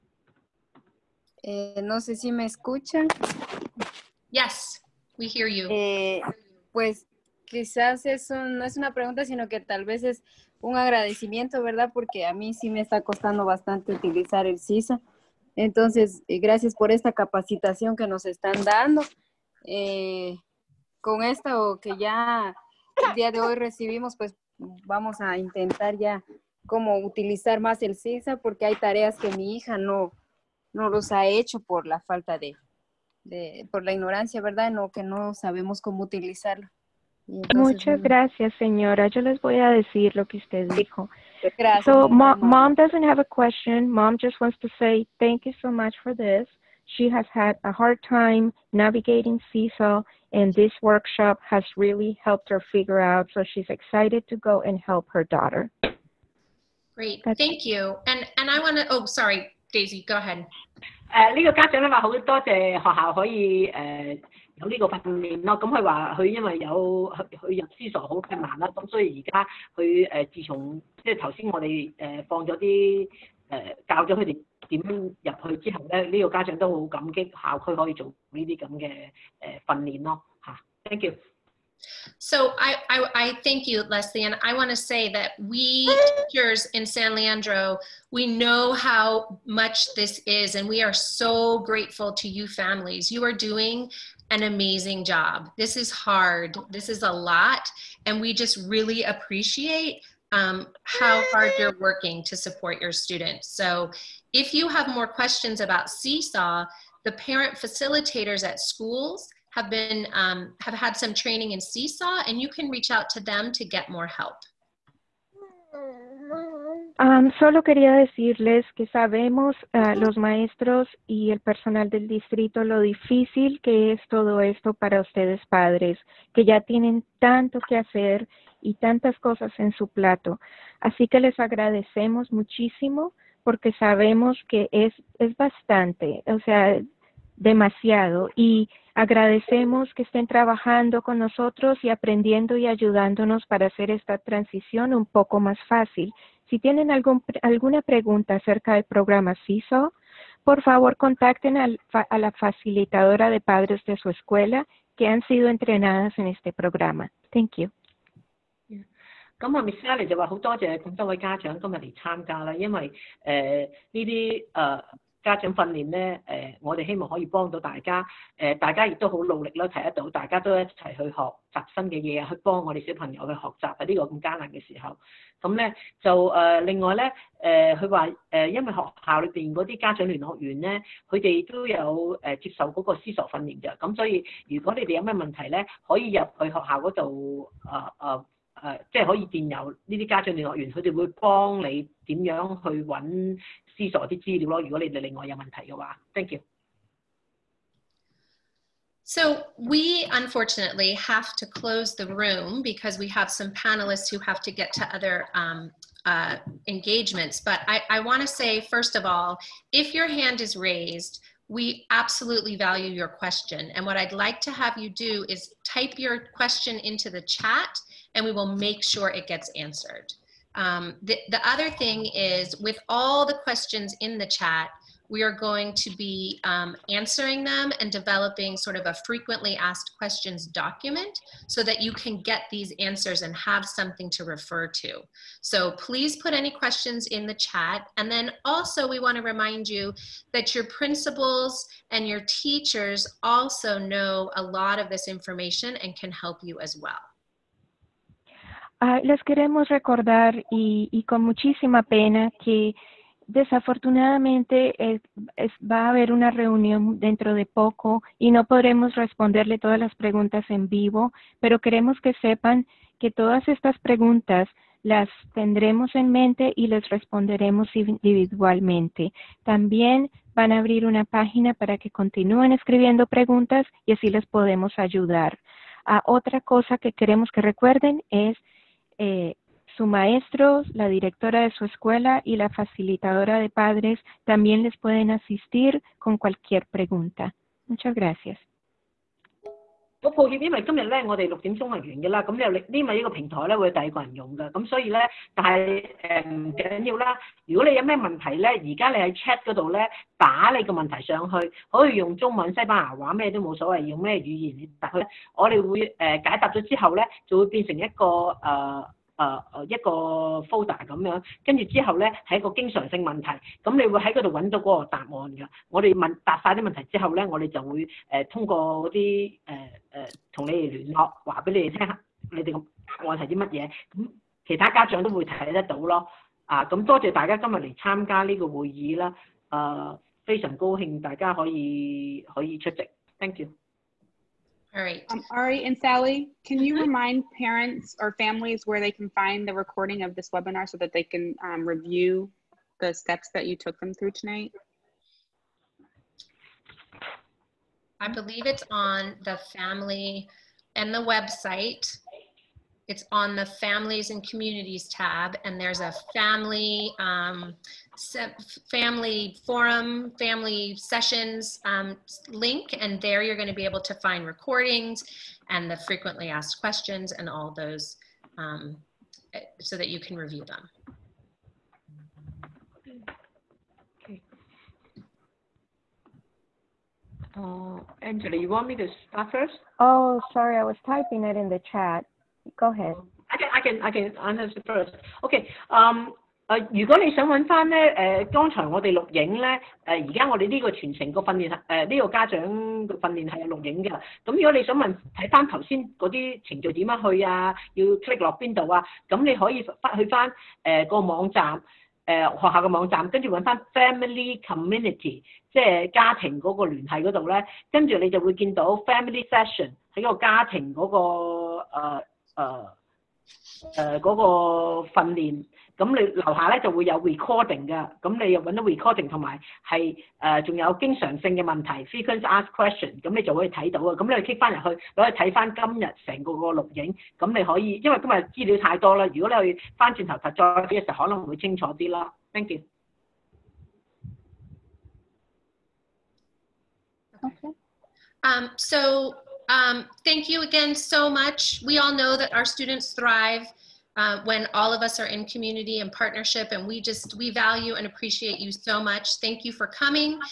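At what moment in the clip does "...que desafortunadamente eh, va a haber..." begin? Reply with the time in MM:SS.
04:12.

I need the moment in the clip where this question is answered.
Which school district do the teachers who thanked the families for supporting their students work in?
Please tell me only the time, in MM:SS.
01:26.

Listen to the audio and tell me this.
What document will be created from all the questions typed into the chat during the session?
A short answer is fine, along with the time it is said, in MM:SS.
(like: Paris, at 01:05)
frequently asked questions document, at 03:49.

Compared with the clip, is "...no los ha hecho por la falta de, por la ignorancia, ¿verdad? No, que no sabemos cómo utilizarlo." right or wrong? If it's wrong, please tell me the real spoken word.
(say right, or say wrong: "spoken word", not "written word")
right.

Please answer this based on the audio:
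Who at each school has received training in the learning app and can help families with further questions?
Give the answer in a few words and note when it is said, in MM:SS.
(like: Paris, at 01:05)
parent facilitators, at 01:47.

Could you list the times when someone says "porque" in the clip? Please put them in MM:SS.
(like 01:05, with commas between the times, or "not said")
00:11, 00:28, 02:13.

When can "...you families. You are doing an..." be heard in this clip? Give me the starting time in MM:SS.
01:32.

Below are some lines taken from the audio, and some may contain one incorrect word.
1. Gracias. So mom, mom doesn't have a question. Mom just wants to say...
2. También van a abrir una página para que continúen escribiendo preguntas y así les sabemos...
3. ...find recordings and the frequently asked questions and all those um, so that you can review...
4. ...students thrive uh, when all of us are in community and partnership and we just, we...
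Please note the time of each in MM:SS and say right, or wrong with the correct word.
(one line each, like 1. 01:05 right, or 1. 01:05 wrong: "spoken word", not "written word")
1. 00:41 right
2. 04:29 wrong: "podemos", not "sabemos"
3. 06:03 right
4. 07:22 right.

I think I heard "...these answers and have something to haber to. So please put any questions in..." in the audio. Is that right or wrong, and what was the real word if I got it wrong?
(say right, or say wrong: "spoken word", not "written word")
wrong: "refer", not "haber".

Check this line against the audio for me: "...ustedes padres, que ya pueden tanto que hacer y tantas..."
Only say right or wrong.
wrong.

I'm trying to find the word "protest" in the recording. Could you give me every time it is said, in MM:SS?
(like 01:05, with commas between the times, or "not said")
not said.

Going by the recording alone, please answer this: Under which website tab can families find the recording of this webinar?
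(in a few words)
Families and Communities.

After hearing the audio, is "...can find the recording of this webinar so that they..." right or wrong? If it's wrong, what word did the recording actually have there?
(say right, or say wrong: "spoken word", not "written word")
right.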